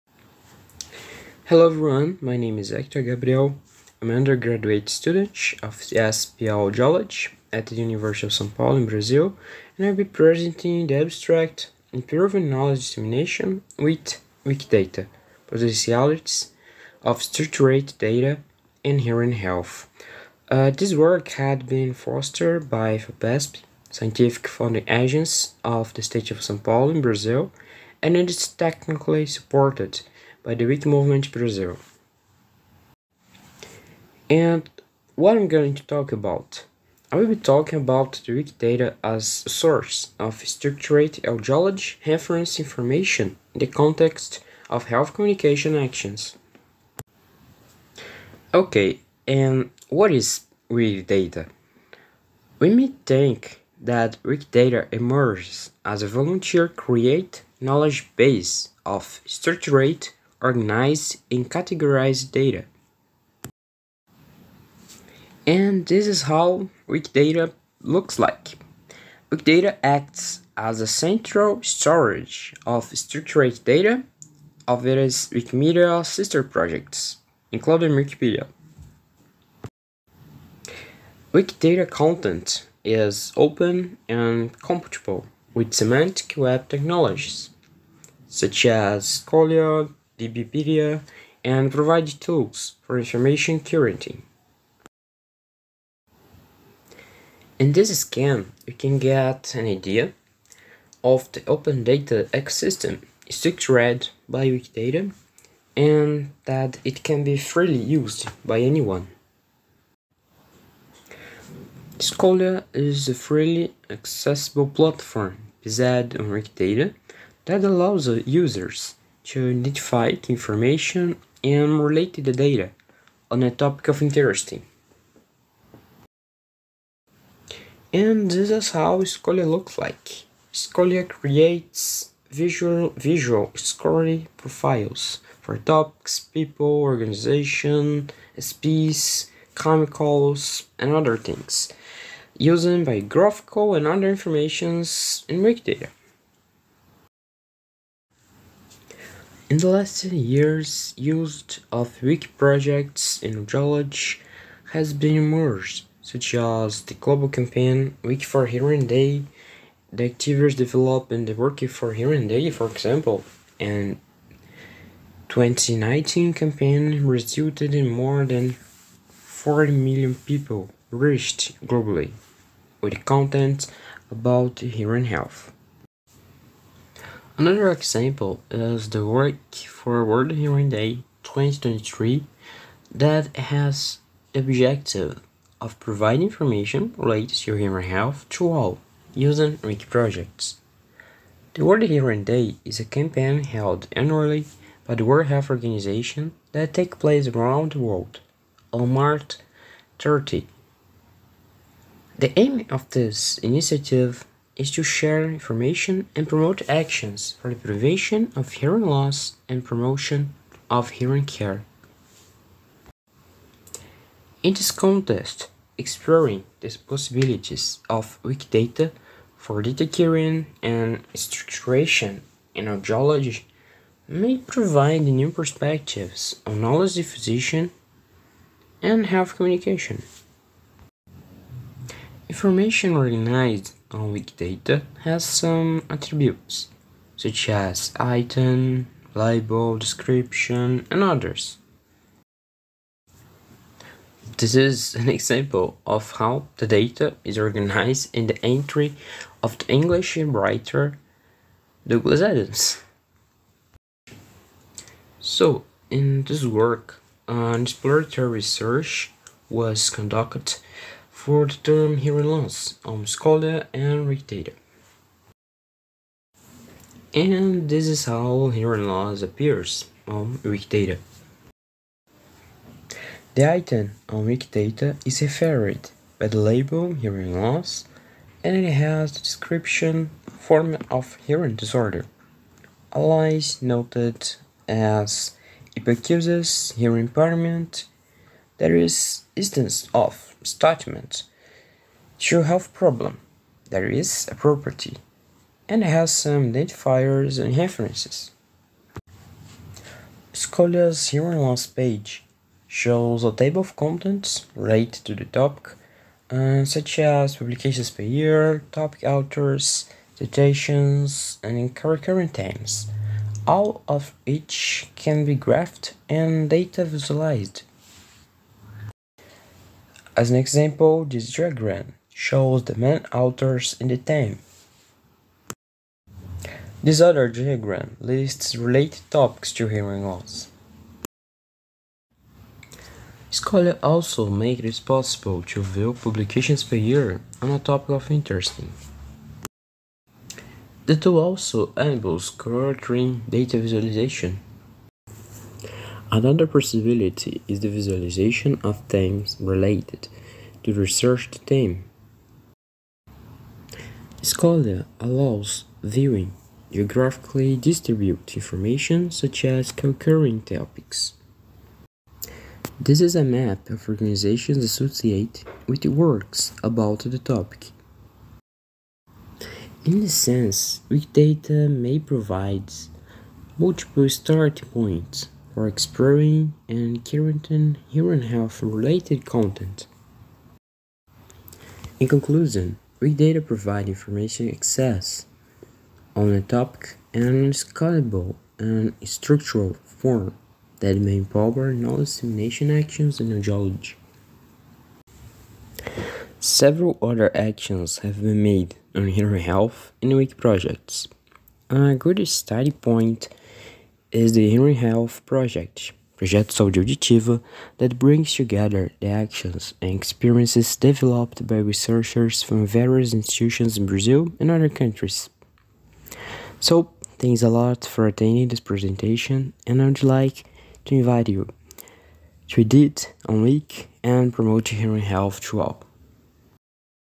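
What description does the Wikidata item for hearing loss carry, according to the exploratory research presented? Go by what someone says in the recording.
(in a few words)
form of hearing disorder.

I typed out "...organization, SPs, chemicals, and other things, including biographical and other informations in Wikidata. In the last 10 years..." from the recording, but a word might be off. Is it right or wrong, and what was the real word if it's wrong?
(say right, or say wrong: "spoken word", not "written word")
wrong: "using", not "including".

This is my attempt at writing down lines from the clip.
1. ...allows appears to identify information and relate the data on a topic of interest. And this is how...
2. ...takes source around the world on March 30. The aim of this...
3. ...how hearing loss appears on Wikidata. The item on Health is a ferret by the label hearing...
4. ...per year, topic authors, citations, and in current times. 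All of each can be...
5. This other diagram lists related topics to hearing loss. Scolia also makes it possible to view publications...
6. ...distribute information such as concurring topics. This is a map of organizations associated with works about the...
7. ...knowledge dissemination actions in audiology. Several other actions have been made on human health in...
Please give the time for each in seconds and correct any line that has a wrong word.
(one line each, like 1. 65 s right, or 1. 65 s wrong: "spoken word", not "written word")
1. 117 s wrong: "users", not "appears"
2. 196 s wrong: "place", not "source"
3. 268 s wrong: "Wikidata", not "Health"
4. 307 s right
5. 326 s right
6. 357 s right
7. 391 s right.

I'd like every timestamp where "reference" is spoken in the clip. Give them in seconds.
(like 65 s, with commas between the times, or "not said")
42 s, 297 s.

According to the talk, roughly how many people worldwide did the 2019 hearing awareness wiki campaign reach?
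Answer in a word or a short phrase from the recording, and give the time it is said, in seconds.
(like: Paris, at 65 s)
40 million, at 169 s.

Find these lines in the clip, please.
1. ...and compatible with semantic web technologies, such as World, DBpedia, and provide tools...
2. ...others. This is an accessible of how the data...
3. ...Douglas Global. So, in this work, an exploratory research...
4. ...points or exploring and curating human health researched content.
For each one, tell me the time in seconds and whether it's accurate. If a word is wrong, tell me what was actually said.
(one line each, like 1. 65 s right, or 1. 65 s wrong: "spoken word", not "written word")
1. 84 s wrong: "Scolia", not "World"
2. 241 s wrong: "example", not "accessible"
3. 251 s wrong: "Adams", not "Global"
4. 374 s wrong: "related", not "researched".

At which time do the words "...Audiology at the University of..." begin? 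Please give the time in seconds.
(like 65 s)
6 s.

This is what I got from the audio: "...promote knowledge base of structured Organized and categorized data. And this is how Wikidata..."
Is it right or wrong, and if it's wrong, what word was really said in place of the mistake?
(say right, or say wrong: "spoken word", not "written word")
wrong: "create", not "promote".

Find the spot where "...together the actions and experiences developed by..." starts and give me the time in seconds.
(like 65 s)
408 s.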